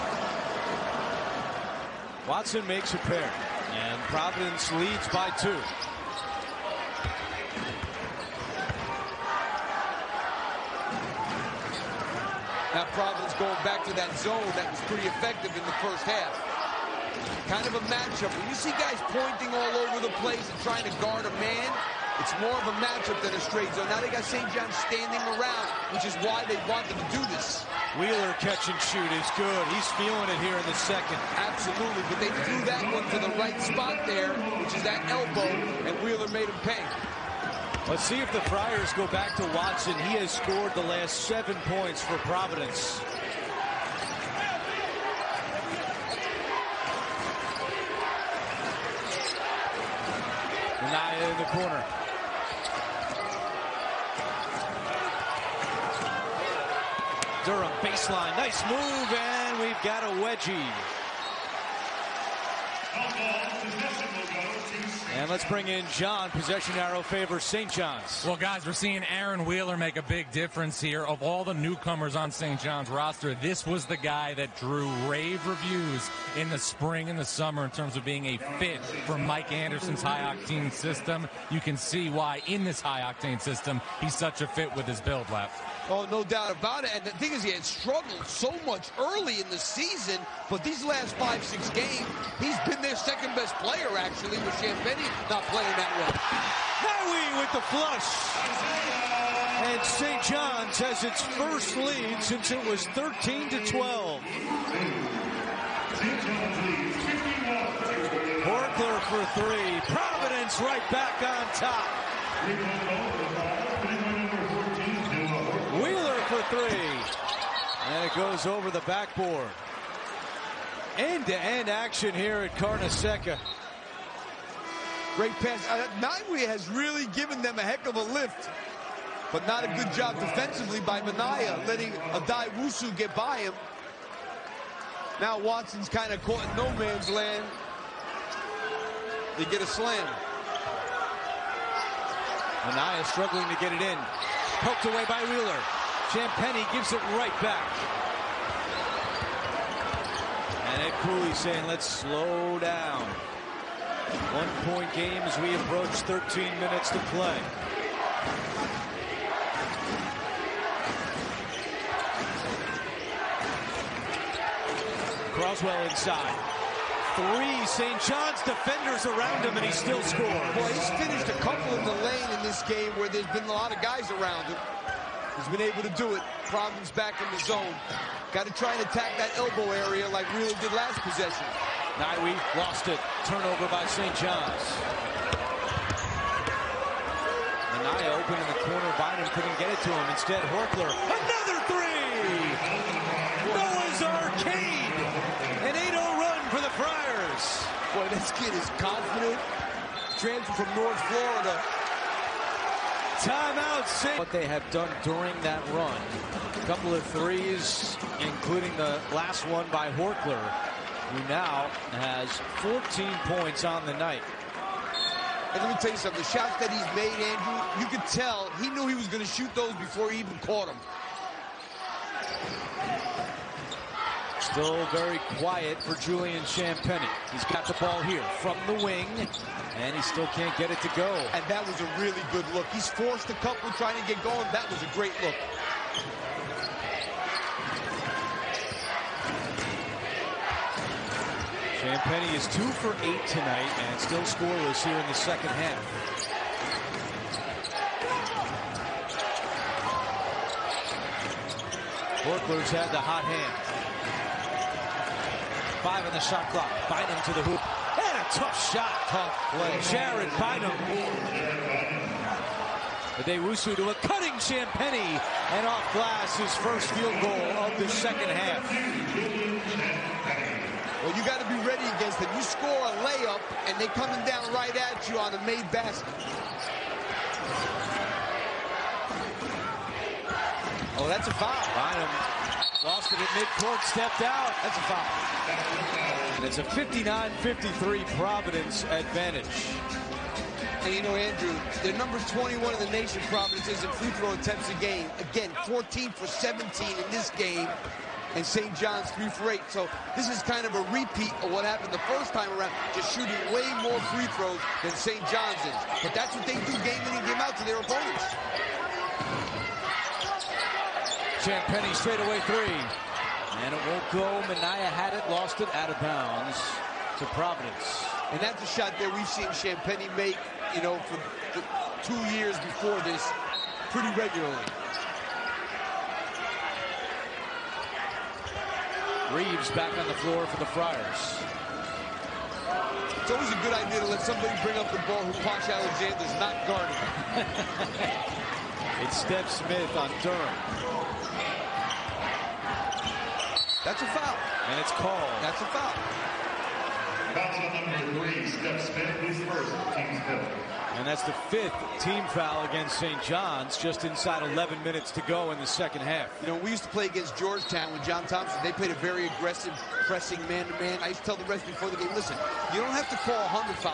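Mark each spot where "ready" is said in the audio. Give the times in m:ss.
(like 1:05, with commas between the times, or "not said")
4:31.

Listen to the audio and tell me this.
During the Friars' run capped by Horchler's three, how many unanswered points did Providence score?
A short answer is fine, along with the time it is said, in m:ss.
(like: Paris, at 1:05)
8, at 3:15.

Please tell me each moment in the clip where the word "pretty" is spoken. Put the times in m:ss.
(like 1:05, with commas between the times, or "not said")
0:14, 5:23.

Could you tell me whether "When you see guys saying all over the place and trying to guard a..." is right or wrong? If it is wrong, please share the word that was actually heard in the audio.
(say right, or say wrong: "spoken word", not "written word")
wrong: "pointing", not "saying".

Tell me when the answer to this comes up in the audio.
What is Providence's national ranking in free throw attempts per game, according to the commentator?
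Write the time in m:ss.
4:51.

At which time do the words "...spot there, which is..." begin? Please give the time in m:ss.
0:33.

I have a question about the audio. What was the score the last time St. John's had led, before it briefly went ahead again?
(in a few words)
13 to 12.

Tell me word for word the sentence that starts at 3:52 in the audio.
He's forced a couple trying to get going.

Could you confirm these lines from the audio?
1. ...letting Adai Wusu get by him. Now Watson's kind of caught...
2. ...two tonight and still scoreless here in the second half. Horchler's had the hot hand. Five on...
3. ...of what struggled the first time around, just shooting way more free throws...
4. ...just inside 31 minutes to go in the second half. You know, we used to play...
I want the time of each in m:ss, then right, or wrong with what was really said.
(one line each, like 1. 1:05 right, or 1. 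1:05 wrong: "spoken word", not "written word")
1. 2:11 right
2. 4:03 wrong: "eight", not "two"
3. 5:01 wrong: "happened", not "struggled"
4. 5:53 wrong: "11", not "31".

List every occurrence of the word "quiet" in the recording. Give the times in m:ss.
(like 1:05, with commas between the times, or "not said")
3:45.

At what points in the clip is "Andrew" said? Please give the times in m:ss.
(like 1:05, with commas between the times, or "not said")
3:37, 4:51.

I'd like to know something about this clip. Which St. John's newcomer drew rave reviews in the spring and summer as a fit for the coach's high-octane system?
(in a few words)
Aaron Wheeler.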